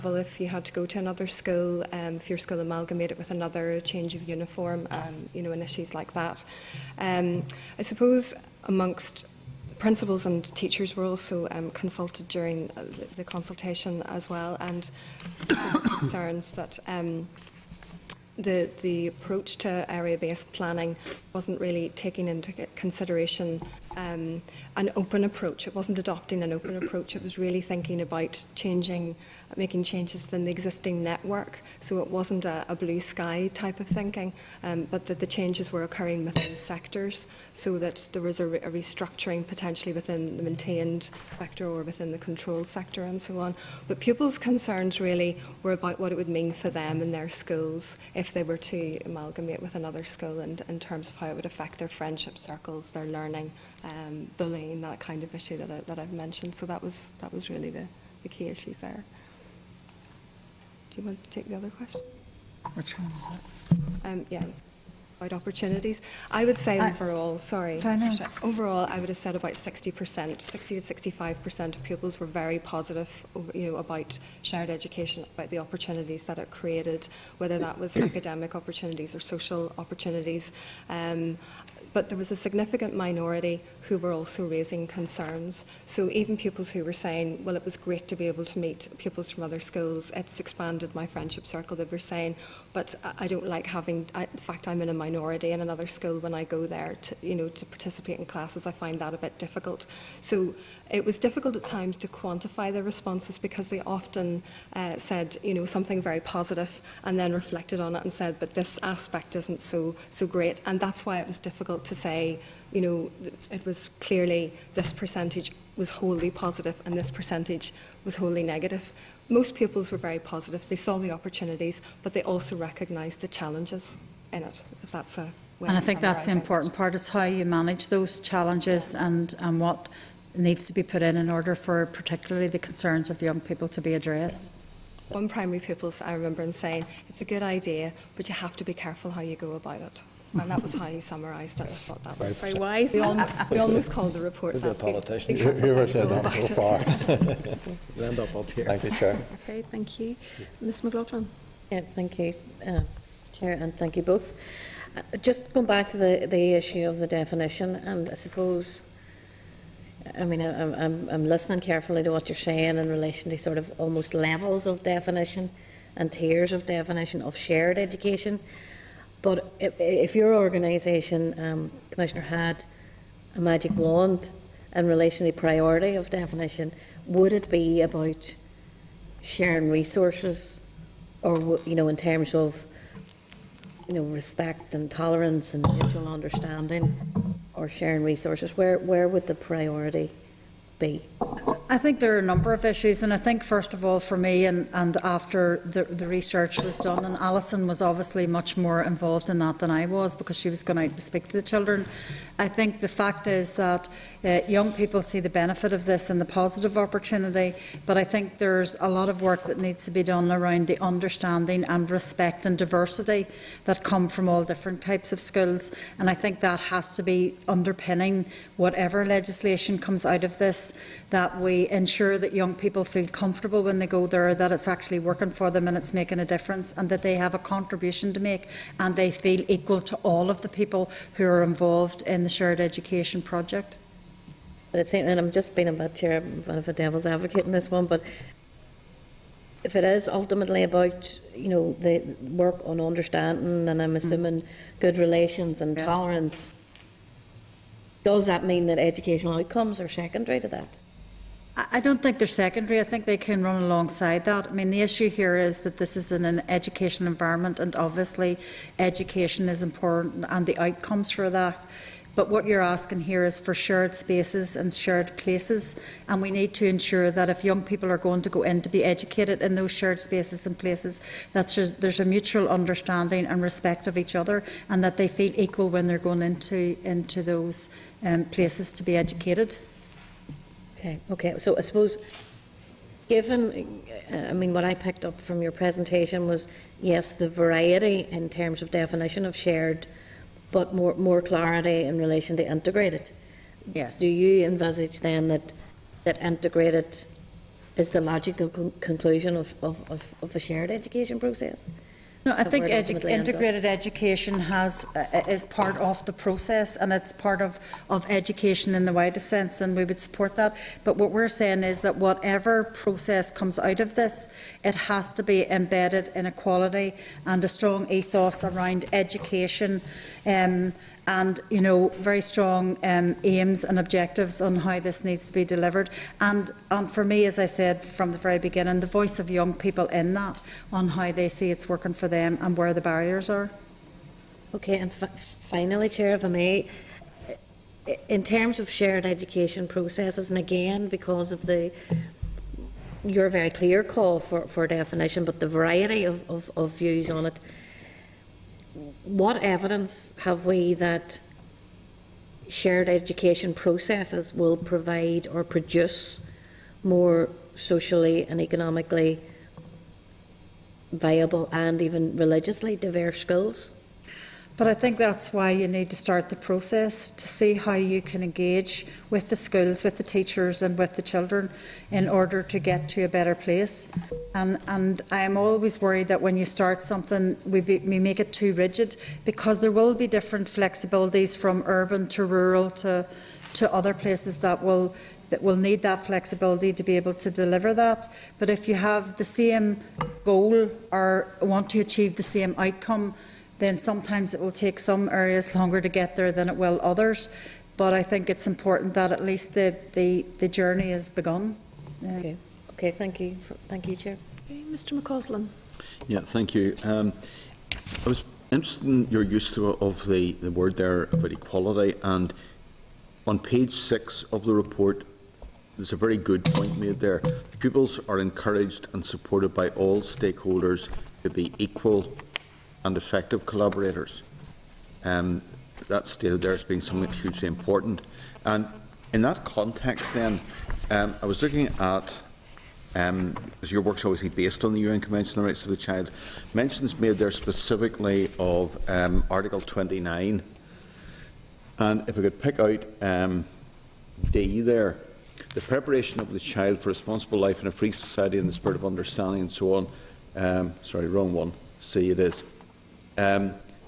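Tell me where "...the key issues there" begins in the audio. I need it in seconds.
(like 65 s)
58 s.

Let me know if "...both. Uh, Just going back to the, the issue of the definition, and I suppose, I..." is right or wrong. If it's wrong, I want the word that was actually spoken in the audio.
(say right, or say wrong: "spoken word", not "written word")
right.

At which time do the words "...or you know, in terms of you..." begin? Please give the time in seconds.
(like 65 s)
181 s.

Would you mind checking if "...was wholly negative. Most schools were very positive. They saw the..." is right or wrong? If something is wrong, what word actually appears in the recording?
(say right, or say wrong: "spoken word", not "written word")
wrong: "pupils", not "schools".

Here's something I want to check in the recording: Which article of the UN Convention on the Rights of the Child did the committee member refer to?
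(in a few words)
Article 29.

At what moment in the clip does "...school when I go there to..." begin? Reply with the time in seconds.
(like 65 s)
95 s.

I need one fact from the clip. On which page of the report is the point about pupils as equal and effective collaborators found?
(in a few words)
6.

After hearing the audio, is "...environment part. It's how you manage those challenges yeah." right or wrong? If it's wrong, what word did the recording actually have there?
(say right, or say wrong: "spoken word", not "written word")
wrong: "important", not "environment".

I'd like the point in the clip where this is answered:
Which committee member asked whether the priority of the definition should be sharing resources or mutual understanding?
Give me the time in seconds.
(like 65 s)
150 s.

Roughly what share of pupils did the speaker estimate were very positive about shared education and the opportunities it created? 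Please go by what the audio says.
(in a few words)
60 to 65%.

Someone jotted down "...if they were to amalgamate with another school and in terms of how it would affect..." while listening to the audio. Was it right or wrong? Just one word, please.
right.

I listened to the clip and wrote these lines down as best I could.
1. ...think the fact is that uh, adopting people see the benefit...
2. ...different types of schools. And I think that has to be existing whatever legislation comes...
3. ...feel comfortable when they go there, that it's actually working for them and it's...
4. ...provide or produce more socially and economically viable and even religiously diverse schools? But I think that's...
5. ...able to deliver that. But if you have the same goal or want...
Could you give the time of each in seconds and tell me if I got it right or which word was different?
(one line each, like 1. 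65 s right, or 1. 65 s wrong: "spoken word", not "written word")
1. 202 s wrong: "young", not "adopting"
2. 214 s wrong: "underpinning", not "existing"
3. 222 s right
4. 354 s right
5. 386 s right.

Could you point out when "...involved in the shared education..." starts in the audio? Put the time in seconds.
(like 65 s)
231 s.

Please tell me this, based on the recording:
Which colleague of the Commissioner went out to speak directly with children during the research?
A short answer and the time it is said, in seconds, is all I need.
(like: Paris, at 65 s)
Alison, at 197 s.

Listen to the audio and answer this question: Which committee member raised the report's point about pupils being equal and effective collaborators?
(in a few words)
Mr McCausland.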